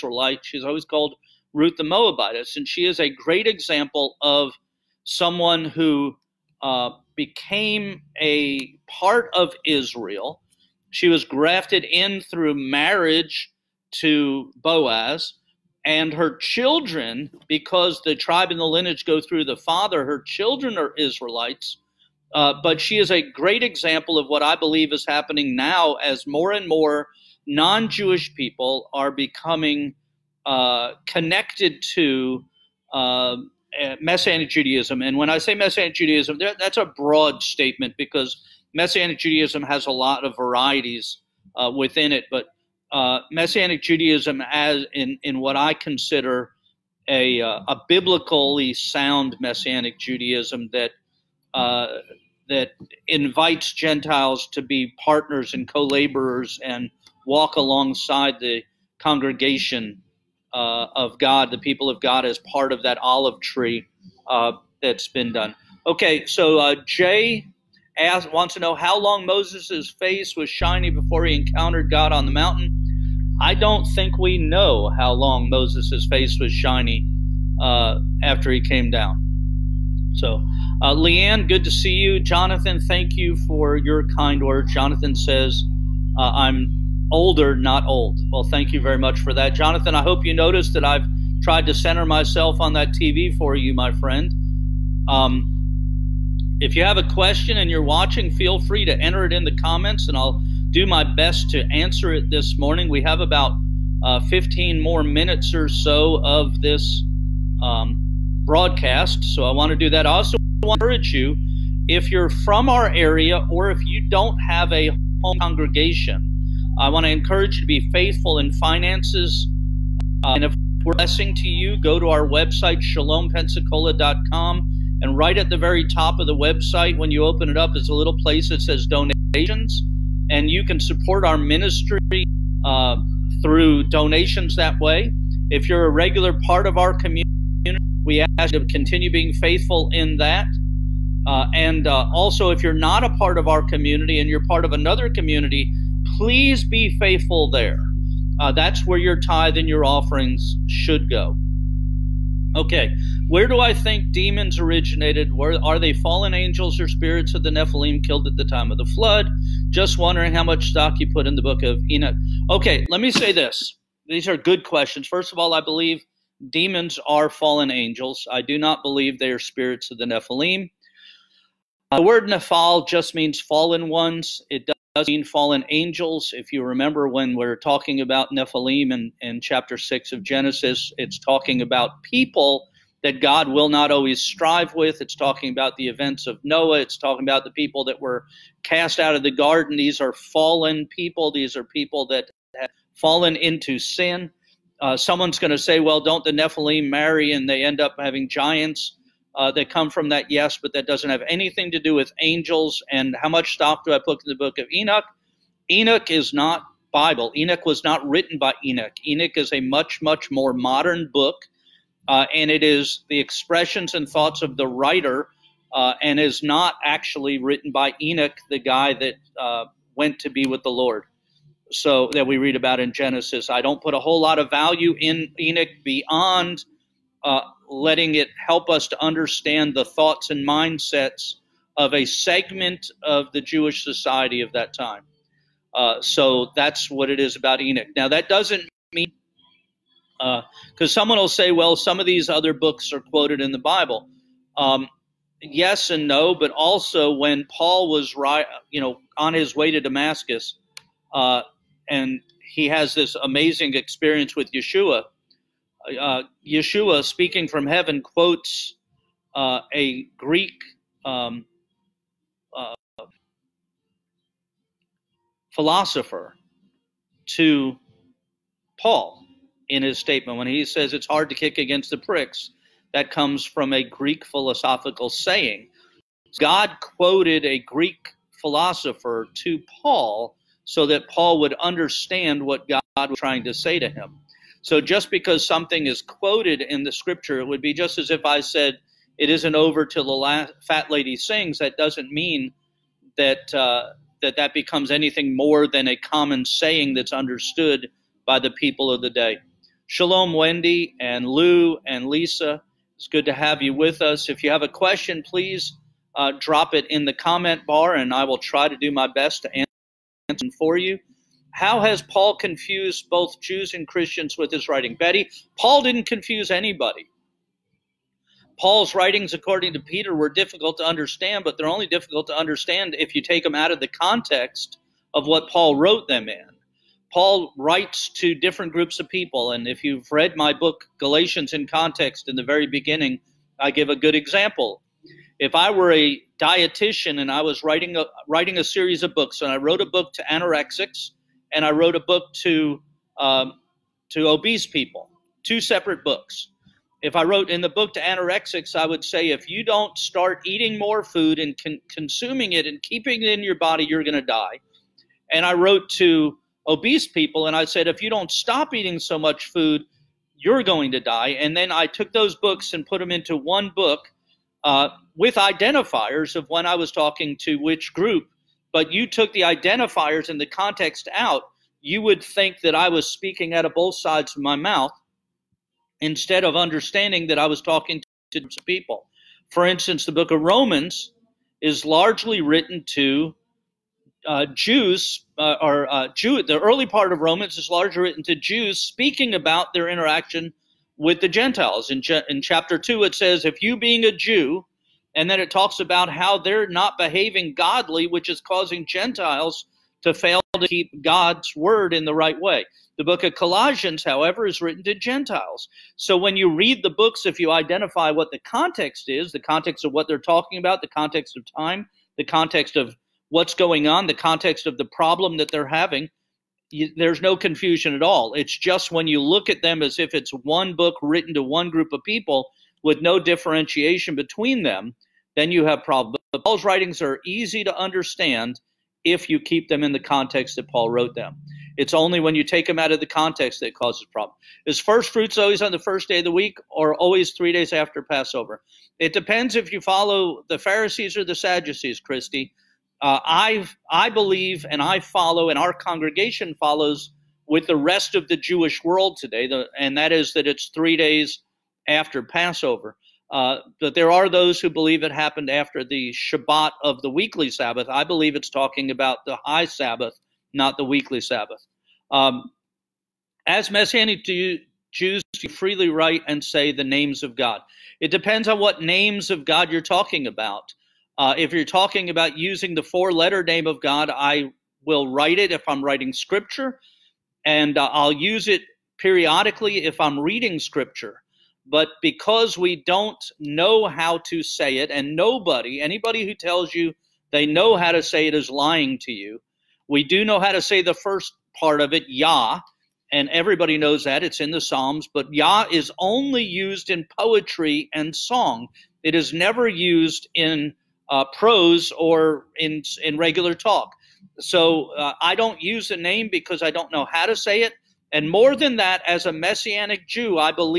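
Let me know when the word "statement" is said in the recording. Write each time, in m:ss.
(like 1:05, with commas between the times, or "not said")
0:37, 4:29.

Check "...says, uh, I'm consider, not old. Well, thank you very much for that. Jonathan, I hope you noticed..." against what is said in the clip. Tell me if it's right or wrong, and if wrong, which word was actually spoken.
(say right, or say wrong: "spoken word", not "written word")
wrong: "older", not "consider".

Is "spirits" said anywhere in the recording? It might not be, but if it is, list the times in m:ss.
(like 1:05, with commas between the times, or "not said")
2:36, 2:49.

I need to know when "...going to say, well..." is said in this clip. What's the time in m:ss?
3:15.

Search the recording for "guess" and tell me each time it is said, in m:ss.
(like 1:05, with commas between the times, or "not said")
not said.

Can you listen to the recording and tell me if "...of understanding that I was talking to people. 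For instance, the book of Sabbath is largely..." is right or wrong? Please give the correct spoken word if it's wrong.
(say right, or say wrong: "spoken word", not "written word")
wrong: "Romans", not "Sabbath".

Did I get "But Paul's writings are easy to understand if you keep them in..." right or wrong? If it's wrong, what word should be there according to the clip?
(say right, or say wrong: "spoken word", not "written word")
right.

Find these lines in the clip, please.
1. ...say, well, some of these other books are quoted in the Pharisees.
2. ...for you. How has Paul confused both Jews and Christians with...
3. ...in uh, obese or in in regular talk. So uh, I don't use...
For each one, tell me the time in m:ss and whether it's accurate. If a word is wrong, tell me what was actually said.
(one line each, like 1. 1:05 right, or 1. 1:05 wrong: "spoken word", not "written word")
1. 4:01 wrong: "Bible", not "Pharisees"
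2. 5:10 right
3. 8:20 wrong: "prose", not "obese".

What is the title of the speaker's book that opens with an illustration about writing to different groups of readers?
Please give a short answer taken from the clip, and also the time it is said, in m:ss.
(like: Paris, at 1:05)
Galatians in Context, at 5:30.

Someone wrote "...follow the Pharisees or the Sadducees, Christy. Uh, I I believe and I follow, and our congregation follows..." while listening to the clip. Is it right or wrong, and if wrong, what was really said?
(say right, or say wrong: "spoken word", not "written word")
right.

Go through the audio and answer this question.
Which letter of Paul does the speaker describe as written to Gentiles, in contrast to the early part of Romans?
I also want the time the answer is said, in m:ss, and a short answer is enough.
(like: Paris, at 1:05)
Colossians, at 6:43.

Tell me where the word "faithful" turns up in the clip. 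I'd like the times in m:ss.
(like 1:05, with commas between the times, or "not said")
1:57, 2:19, 2:26.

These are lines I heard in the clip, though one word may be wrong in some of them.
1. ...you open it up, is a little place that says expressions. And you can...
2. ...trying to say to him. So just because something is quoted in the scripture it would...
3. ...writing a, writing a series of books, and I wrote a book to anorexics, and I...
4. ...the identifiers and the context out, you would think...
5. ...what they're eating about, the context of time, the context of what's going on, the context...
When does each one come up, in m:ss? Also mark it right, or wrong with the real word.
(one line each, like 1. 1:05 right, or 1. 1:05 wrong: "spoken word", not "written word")
1. 2:07 wrong: "donations", not "expressions"
2. 4:43 right
3. 5:37 right
4. 6:09 right
5. 6:49 wrong: "talking", not "eating".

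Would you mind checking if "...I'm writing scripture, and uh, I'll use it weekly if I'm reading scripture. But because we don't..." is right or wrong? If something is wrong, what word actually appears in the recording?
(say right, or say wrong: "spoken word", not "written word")
wrong: "periodically", not "weekly".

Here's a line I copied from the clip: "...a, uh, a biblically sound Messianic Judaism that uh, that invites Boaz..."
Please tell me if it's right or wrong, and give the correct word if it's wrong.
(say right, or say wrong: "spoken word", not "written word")
wrong: "Gentiles", not "Boaz".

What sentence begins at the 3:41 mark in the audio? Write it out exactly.
So that we read about in Genesis.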